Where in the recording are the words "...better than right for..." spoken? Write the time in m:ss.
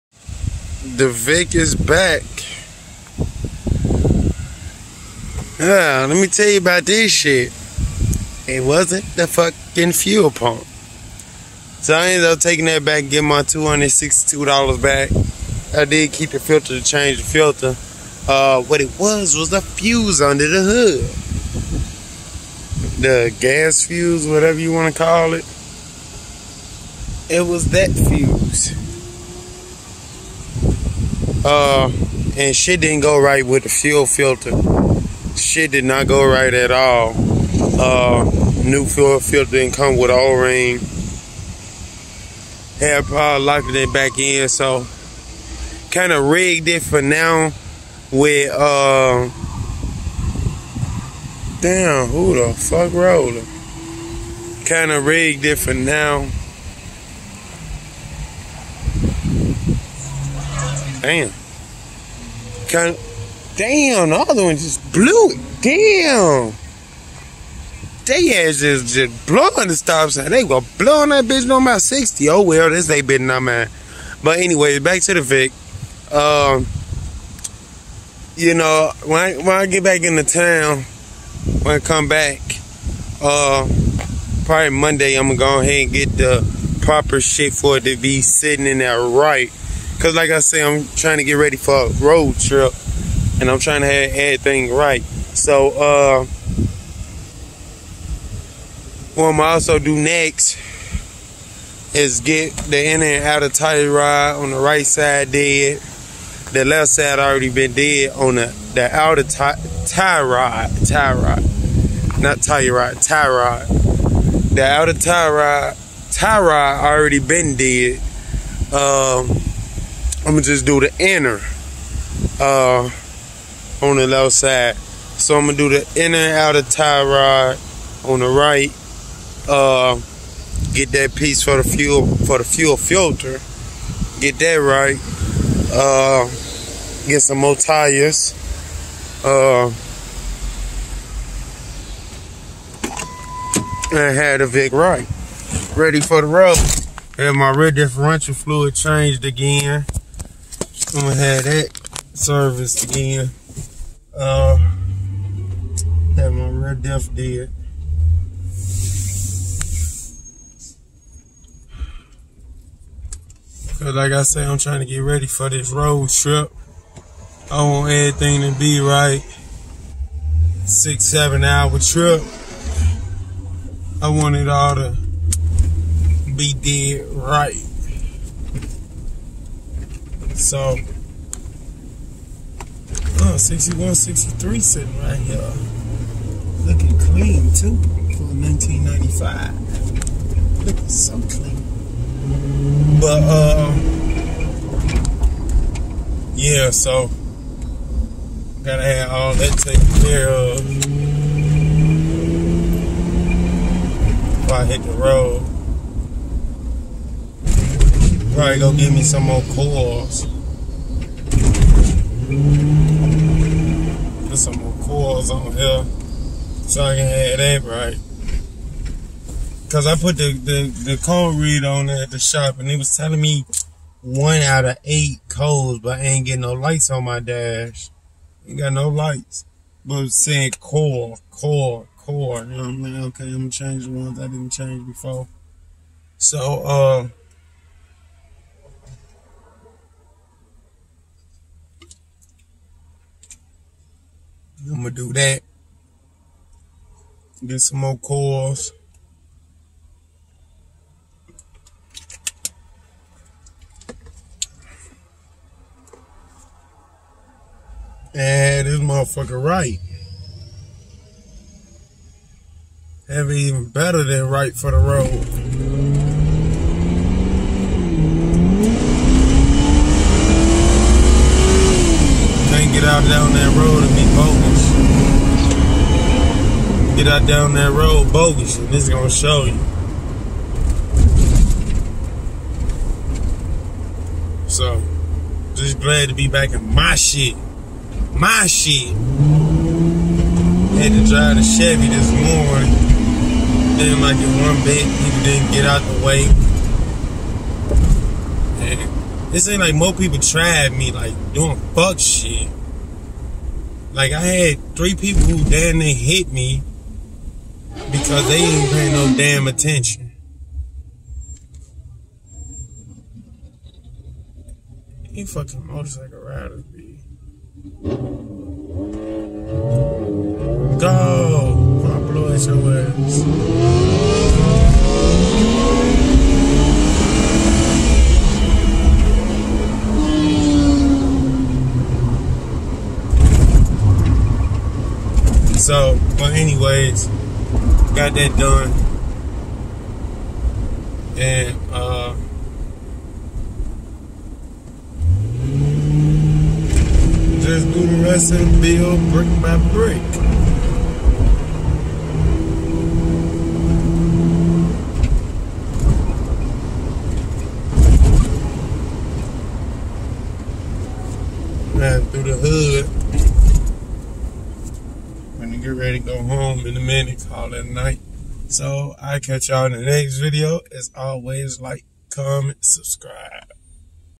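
4:23.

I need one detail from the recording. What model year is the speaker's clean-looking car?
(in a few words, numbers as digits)
1995.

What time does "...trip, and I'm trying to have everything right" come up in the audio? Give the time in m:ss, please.
1:32.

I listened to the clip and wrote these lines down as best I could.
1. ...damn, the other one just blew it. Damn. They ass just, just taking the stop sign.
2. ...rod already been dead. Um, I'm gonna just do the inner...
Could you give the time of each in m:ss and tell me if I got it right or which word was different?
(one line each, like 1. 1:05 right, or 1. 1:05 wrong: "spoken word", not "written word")
1. 1:03 wrong: "blowing", not "taking"
2. 1:56 right.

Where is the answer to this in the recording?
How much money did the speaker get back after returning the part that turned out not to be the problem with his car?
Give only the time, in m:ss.
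0:13.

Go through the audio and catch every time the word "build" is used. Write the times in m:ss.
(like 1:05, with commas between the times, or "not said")
5:48.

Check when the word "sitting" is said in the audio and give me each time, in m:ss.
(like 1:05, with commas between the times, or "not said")
1:28, 3:04.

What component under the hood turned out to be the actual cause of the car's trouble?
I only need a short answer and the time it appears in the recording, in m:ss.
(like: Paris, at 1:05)
The fuse, at 0:19.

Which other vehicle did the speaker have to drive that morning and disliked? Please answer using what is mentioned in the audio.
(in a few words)
The Chevy.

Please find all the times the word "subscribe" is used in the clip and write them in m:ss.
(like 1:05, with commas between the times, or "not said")
6:12.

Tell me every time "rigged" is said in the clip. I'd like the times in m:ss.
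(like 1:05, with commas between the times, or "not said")
0:46, 0:55.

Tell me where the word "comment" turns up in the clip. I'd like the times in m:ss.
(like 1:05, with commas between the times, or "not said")
6:12.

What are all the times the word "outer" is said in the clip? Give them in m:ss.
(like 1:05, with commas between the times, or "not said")
1:43, 1:48, 1:54, 2:06.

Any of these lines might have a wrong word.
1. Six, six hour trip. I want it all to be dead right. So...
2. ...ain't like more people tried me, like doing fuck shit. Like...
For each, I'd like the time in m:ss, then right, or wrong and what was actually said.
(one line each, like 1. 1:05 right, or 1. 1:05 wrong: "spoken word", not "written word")
1. 2:50 wrong: "seven", not "six"
2. 4:59 right.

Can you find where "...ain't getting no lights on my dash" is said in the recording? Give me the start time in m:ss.
3:46.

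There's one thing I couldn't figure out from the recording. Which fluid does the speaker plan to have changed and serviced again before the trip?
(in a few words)
Rear differential fluid.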